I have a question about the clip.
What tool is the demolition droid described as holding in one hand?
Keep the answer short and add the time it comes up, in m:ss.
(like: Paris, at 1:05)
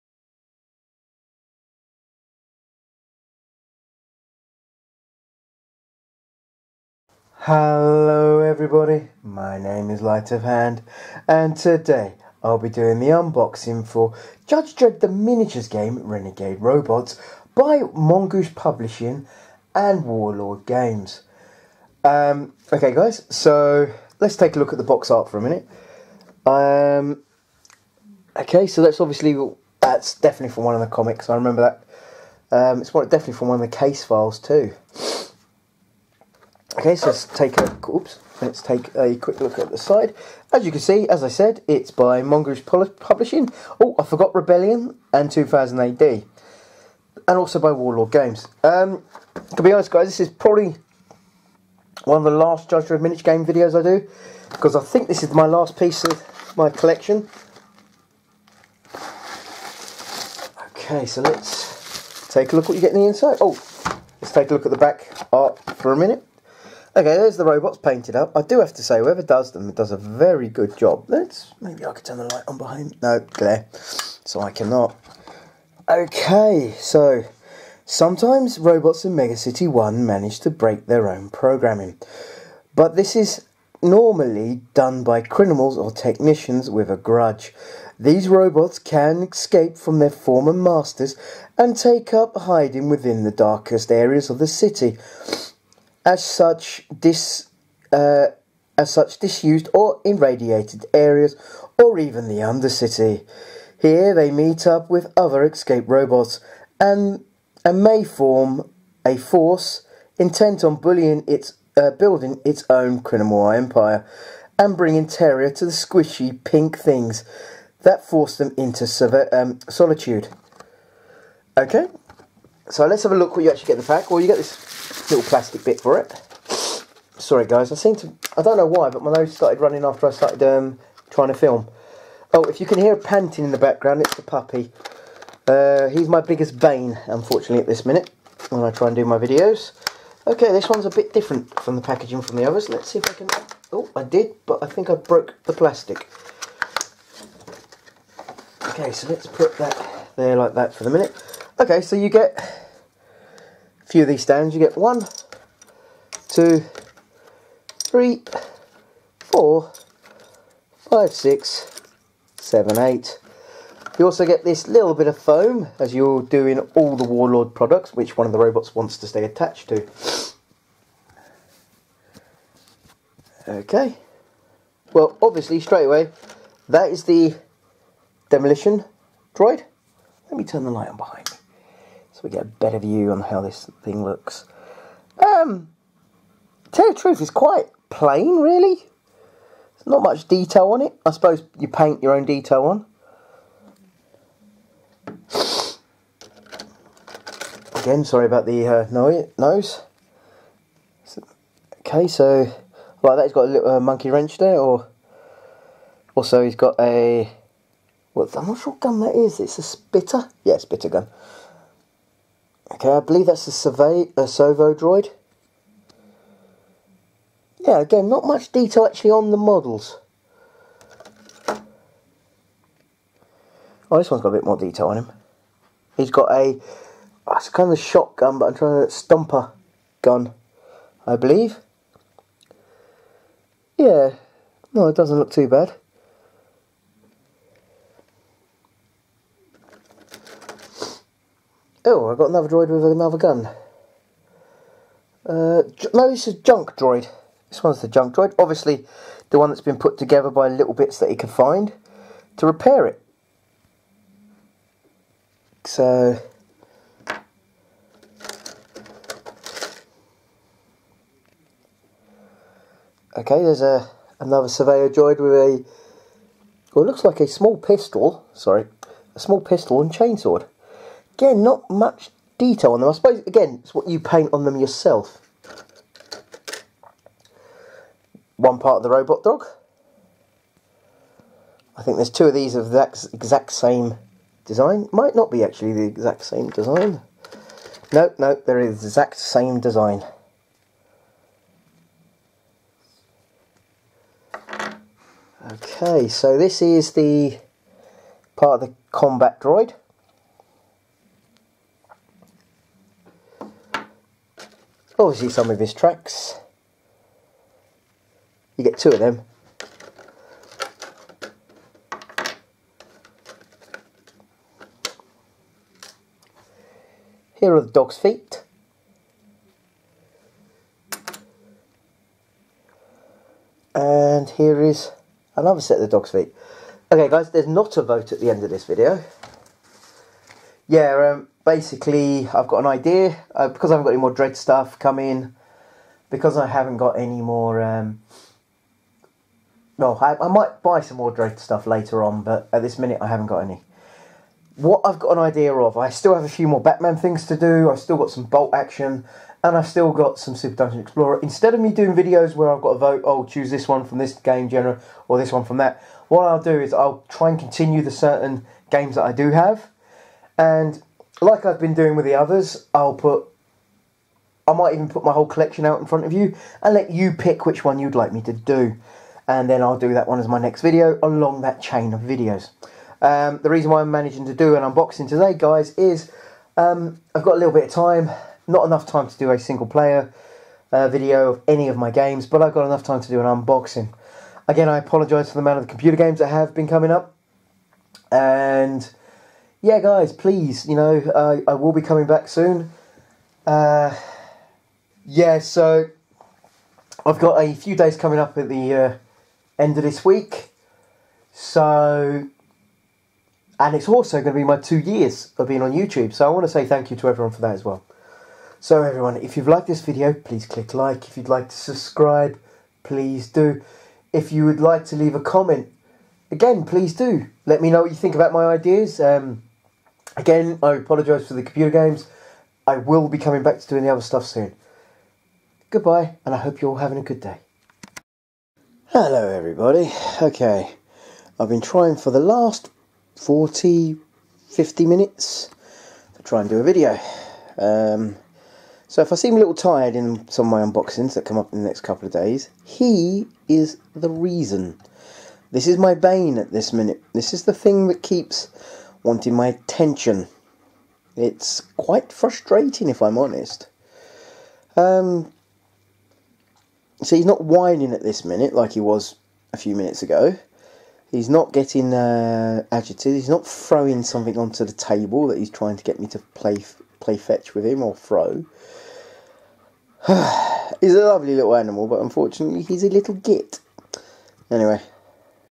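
monkey wrench, at 3:23.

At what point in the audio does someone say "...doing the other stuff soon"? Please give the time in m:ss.
7:03.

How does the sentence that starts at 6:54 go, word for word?
If you would like to leave a comment, again, please do.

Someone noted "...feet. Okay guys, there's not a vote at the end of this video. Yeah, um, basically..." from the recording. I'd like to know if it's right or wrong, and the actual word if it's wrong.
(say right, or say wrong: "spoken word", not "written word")
right.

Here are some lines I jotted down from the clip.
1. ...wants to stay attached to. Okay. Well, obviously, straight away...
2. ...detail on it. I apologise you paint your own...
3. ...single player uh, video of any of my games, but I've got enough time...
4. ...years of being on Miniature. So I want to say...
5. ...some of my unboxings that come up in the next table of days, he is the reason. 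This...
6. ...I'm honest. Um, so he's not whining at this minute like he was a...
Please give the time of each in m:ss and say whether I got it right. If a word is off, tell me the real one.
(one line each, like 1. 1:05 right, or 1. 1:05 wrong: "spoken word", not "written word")
1. 2:48 right
2. 3:10 wrong: "suppose", not "apologise"
3. 6:19 right
4. 6:44 wrong: "YouTube", not "Miniature"
5. 7:20 wrong: "couple", not "table"
6. 7:33 right.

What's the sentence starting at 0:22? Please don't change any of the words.
Um, okay guys, so let's take a look at the box art for a minute.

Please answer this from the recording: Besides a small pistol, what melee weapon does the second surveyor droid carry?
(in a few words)
chainsword.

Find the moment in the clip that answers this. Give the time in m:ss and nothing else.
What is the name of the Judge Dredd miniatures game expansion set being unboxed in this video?
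0:16.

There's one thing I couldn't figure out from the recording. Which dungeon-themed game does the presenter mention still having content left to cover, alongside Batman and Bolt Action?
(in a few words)
Super Dungeon Explorer.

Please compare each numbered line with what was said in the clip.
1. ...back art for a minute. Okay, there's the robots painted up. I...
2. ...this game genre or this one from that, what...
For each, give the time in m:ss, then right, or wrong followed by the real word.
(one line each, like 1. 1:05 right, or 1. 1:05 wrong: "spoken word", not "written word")
1. 1:04 right
2. 5:53 right.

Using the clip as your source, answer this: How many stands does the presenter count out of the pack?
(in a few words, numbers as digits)
8.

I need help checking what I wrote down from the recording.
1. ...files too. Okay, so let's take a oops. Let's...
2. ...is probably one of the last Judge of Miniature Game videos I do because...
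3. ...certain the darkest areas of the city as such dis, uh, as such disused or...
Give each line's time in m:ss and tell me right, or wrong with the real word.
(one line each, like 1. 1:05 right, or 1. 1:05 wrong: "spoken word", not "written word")
1. 0:34 right
2. 0:50 right
3. 1:32 wrong: "within", not "certain".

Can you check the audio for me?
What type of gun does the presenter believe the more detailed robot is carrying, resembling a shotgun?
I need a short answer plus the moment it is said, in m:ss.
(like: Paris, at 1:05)
stumper gun, at 3:48.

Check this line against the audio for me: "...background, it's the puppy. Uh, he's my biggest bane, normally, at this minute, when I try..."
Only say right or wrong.
wrong.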